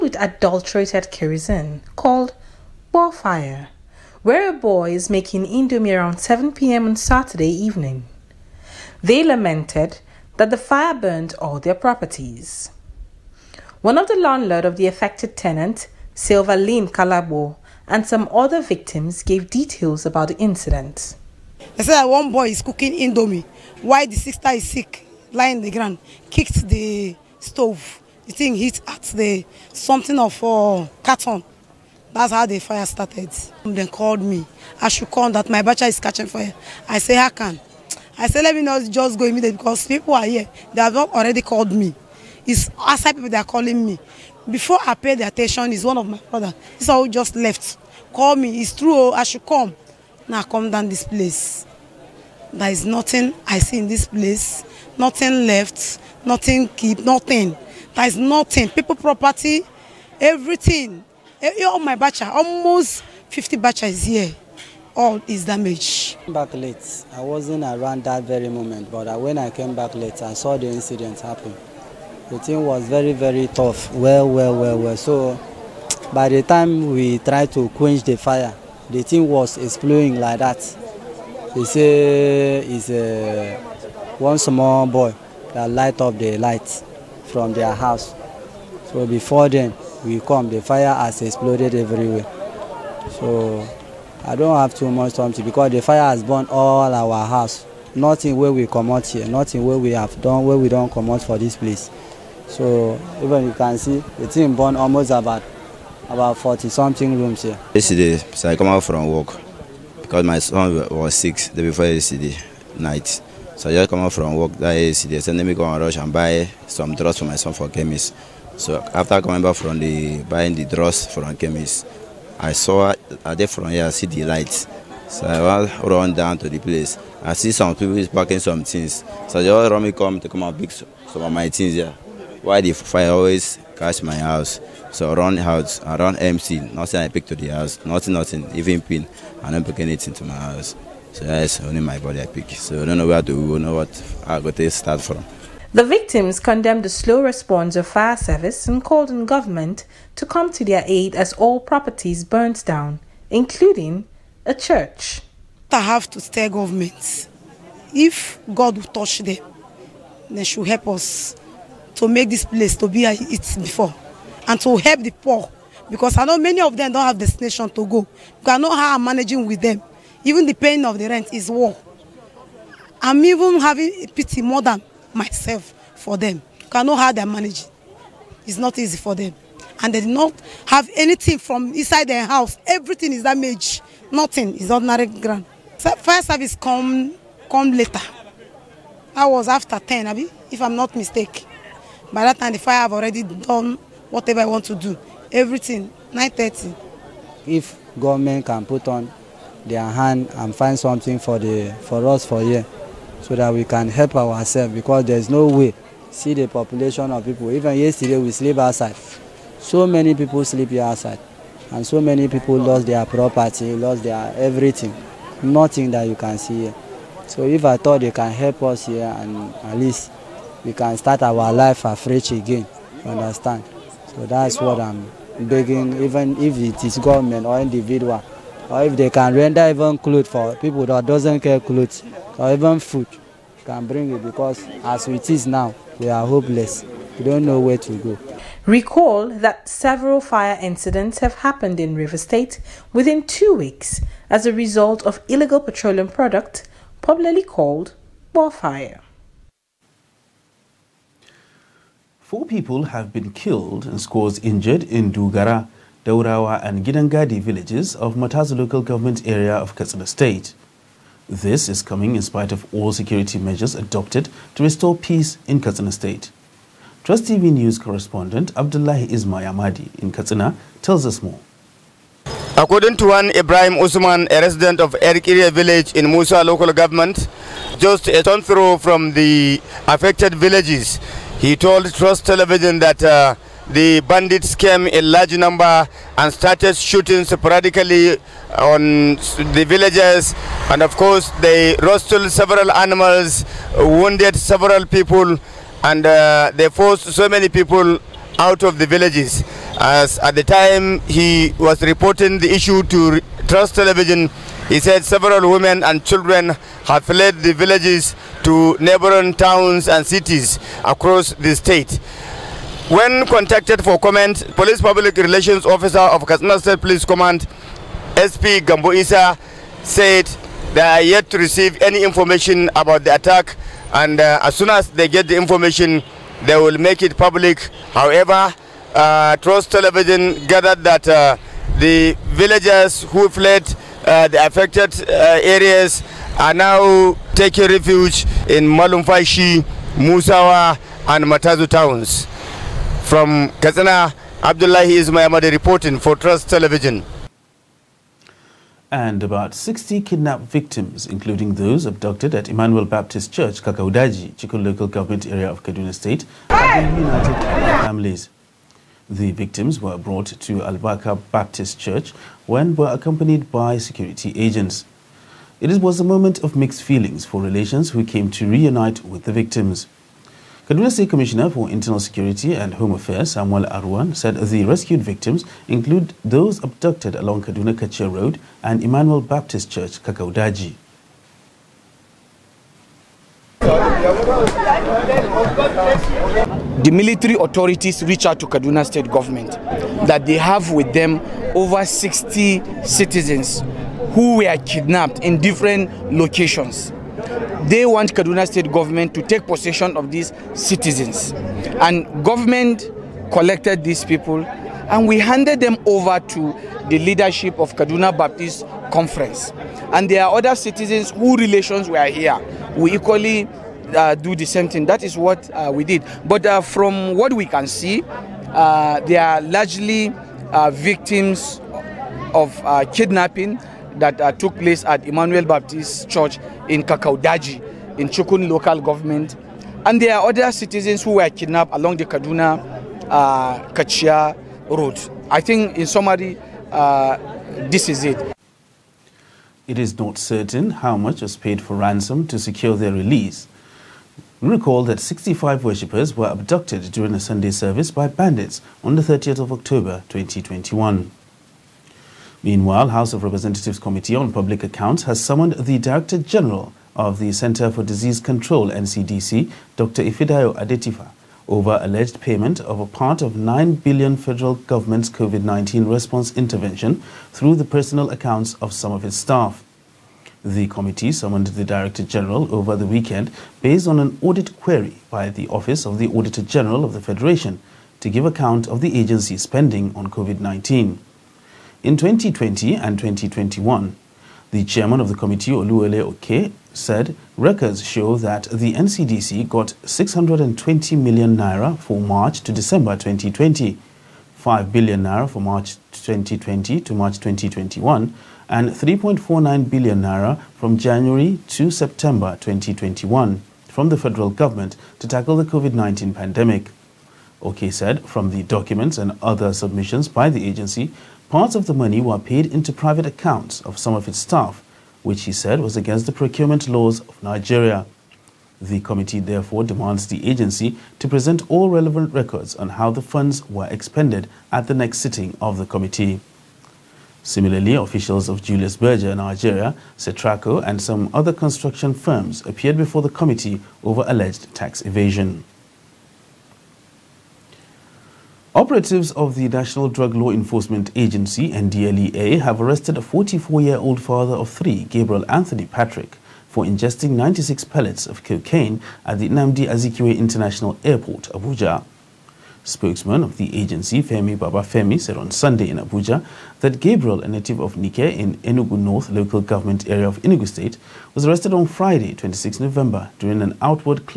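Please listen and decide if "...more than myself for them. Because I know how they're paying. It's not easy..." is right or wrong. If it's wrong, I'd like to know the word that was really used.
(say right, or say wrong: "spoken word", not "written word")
wrong: "managing", not "paying".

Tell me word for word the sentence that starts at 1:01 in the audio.
Eh, eh, all my bacha, almost 50 bacha is here.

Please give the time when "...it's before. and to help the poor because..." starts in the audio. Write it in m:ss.
2:43.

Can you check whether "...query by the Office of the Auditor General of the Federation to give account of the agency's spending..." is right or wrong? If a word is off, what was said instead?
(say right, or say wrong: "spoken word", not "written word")
right.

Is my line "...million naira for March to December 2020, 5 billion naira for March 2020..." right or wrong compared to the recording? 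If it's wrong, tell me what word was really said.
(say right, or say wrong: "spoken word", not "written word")
right.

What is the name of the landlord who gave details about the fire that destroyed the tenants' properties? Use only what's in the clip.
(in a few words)
Lynn Kalabo.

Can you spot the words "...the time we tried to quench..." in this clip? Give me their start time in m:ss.
1:16.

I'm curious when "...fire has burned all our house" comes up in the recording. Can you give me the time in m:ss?
1:35.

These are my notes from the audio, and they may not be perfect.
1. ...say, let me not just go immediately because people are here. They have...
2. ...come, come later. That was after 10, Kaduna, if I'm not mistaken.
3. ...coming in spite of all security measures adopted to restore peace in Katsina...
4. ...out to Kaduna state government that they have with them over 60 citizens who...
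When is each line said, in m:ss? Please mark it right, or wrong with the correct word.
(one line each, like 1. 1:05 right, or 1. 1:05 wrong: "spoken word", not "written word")
1. 0:38 right
2. 3:06 wrong: "Abby", not "Kaduna"
3. 4:21 right
4. 6:28 right.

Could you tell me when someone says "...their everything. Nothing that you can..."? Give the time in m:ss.
3:34.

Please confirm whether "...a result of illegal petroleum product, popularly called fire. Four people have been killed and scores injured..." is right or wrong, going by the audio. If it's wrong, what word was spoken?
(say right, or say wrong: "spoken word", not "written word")
right.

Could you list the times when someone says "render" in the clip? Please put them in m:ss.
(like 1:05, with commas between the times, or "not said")
3:49.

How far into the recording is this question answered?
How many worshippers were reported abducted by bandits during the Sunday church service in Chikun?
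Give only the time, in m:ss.
7:25.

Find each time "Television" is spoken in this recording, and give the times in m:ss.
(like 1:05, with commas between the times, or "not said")
4:42, 5:03, 5:29, 5:46.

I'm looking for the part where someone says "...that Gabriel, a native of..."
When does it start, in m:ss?
9:16.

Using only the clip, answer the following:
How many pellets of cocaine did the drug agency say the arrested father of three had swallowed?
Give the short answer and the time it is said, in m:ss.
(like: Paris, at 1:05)
96, at 9:07.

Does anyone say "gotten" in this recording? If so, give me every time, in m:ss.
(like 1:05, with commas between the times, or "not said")
not said.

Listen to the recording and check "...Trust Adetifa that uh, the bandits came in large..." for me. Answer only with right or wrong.
wrong.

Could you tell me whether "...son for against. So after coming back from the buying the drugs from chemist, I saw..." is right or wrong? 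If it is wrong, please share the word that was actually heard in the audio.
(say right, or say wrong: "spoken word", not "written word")
wrong: "chemist", not "against".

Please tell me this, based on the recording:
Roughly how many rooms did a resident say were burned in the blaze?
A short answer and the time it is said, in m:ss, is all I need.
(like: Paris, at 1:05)
40, at 1:46.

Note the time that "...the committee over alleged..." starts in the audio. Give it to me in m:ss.
8:53.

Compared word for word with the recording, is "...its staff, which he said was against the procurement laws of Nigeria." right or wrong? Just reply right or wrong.
right.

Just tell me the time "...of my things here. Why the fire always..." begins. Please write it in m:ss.
2:11.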